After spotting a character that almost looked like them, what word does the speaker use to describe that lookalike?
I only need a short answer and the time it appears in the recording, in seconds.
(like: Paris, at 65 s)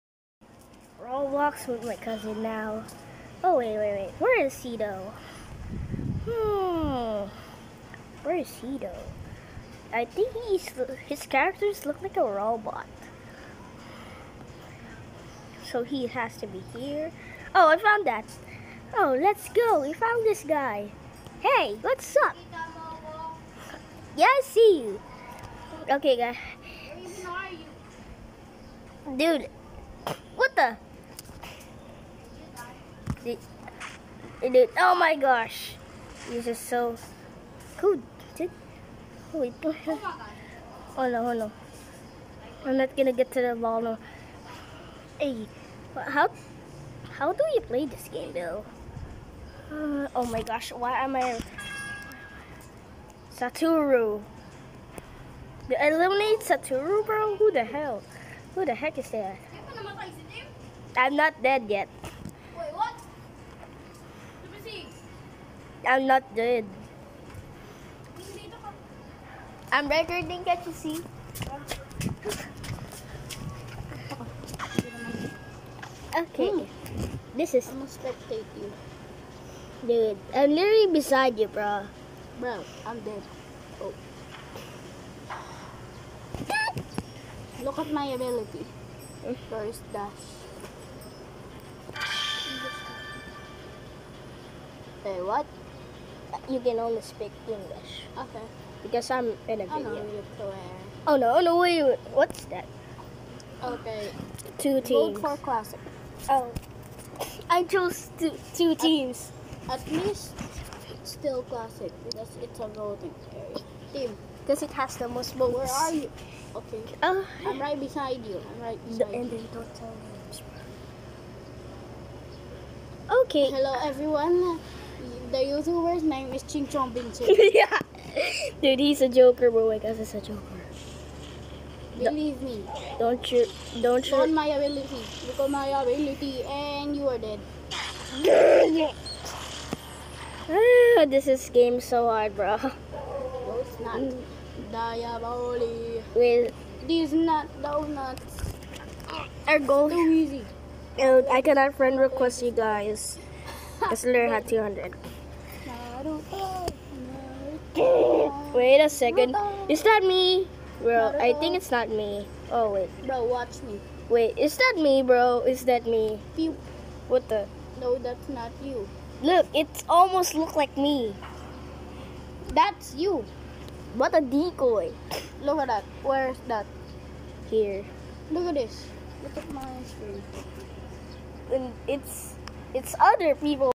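decoy, at 174 s.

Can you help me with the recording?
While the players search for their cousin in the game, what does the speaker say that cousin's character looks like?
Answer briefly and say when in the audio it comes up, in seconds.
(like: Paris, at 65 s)
a robot, at 12 s.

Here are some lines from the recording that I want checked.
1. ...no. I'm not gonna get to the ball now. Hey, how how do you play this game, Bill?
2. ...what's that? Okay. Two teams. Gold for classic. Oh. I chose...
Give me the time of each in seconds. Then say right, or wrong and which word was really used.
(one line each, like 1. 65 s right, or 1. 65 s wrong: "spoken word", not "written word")
1. 41 s right
2. 102 s right.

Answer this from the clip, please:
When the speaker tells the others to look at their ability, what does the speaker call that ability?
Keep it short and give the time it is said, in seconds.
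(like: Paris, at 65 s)
First dash, at 89 s.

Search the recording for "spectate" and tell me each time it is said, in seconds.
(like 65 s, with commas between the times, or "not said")
77 s.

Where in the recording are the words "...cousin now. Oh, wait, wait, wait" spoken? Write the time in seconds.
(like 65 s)
1 s.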